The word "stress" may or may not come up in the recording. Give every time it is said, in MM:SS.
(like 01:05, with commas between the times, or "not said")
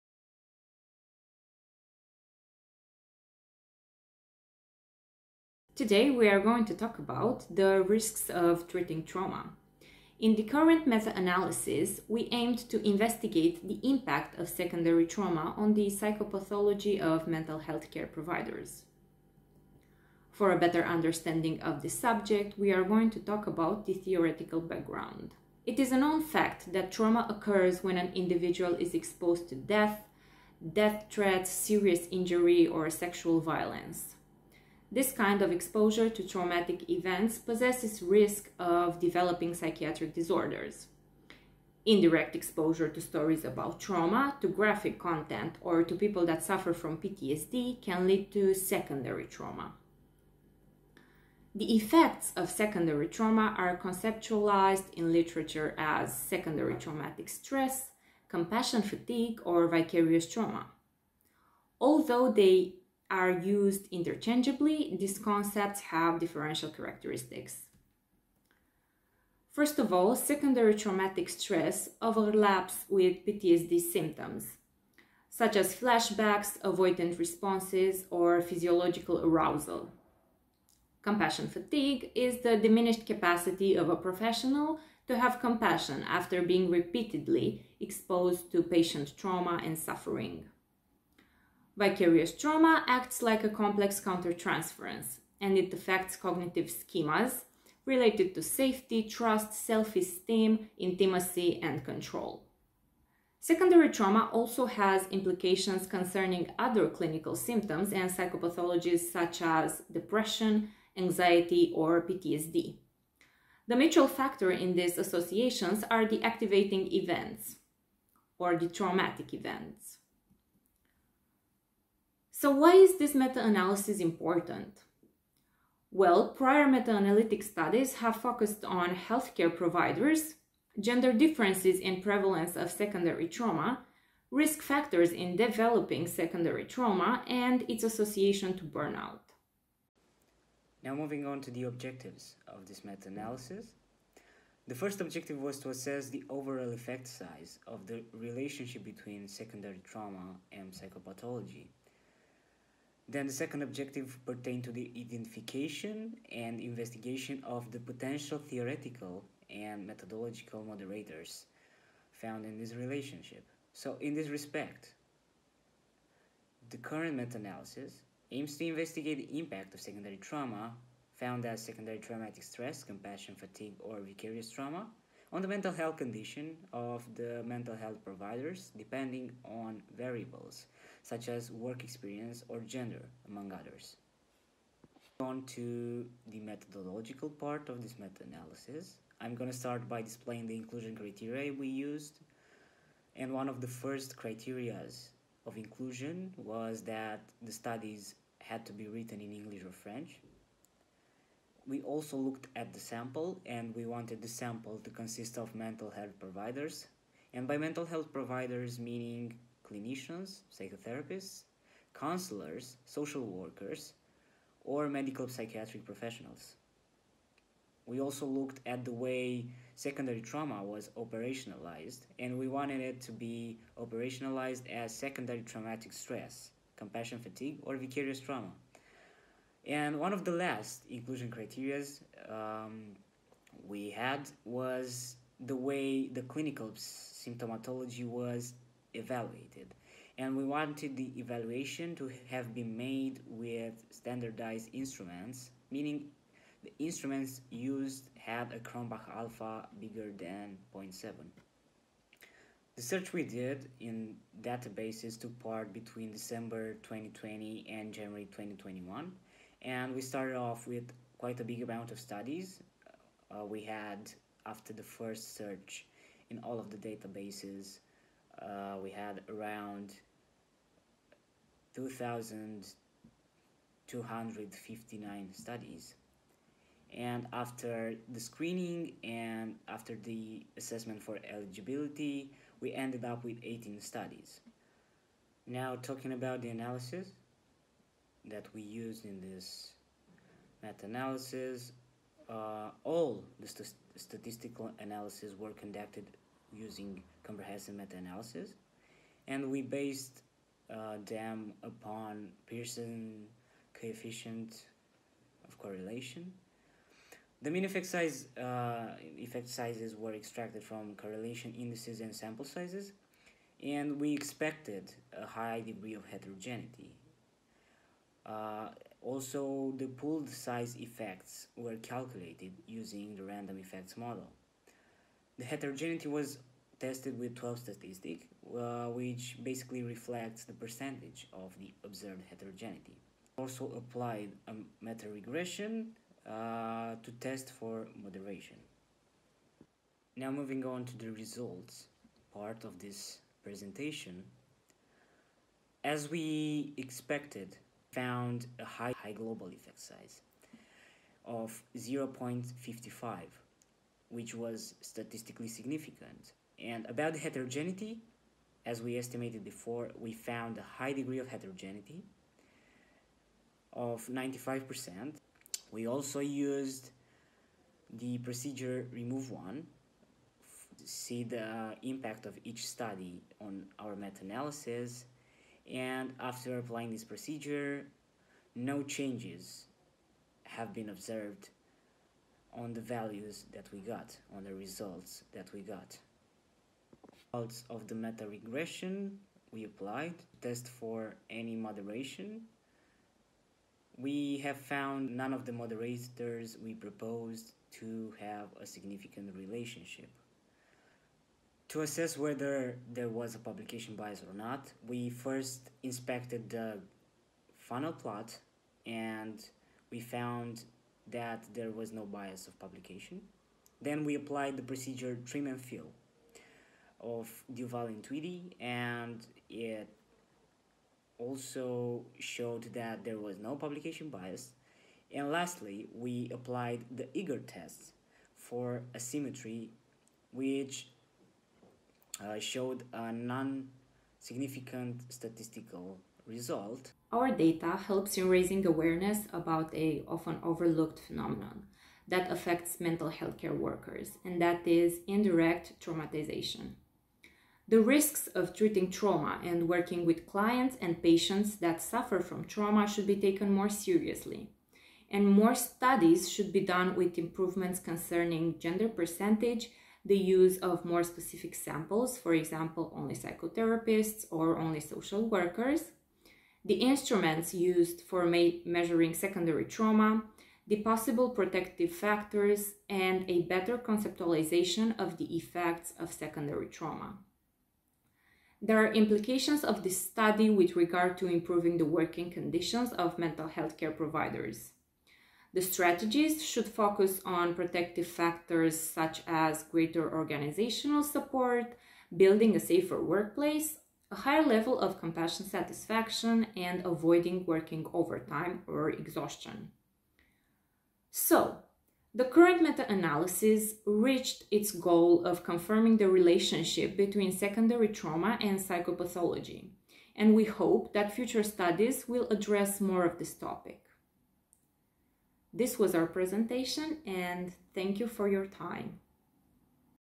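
00:57, 01:11, 02:52, 03:45.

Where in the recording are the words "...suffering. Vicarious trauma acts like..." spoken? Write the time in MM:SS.
01:29.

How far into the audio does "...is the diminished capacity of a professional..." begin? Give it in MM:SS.
01:22.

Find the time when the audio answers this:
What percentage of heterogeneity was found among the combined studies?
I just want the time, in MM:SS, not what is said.
06:04.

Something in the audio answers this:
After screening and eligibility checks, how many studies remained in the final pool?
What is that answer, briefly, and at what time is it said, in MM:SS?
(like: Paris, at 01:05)
18, at 04:43.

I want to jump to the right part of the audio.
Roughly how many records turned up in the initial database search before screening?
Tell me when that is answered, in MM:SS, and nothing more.
04:31.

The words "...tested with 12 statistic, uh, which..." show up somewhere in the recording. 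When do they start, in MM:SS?
05:26.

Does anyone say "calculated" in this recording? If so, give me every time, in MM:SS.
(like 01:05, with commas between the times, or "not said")
05:21.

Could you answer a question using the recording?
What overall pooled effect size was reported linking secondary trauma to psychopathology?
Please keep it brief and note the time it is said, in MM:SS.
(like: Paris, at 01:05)
0.55, at 05:51.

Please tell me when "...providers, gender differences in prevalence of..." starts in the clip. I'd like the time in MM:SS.
02:09.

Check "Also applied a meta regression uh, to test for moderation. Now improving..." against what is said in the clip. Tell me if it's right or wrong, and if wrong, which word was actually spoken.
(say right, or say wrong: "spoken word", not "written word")
wrong: "moving", not "improving".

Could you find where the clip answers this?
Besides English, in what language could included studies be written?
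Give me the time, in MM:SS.
03:19.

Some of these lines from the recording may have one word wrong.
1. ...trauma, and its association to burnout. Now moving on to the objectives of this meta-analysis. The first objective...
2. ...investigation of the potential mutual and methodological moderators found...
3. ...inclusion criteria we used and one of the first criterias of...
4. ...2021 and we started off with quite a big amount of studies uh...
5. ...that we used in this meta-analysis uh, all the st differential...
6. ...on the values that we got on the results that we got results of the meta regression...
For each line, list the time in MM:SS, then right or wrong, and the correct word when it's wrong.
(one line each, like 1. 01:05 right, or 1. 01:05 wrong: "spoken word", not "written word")
1. 02:16 right
2. 02:36 wrong: "theoretical", not "mutual"
3. 03:10 right
4. 04:18 right
5. 04:48 wrong: "statistical", not "differential"
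6. 06:22 right.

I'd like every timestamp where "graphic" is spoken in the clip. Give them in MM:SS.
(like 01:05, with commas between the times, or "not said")
00:44.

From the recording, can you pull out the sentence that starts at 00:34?
This kind of exposure to traumatic events possesses risk of developing psychiatric disorders.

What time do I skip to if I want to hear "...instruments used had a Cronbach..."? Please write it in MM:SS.
04:06.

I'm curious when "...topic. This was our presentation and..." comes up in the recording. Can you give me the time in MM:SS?
08:33.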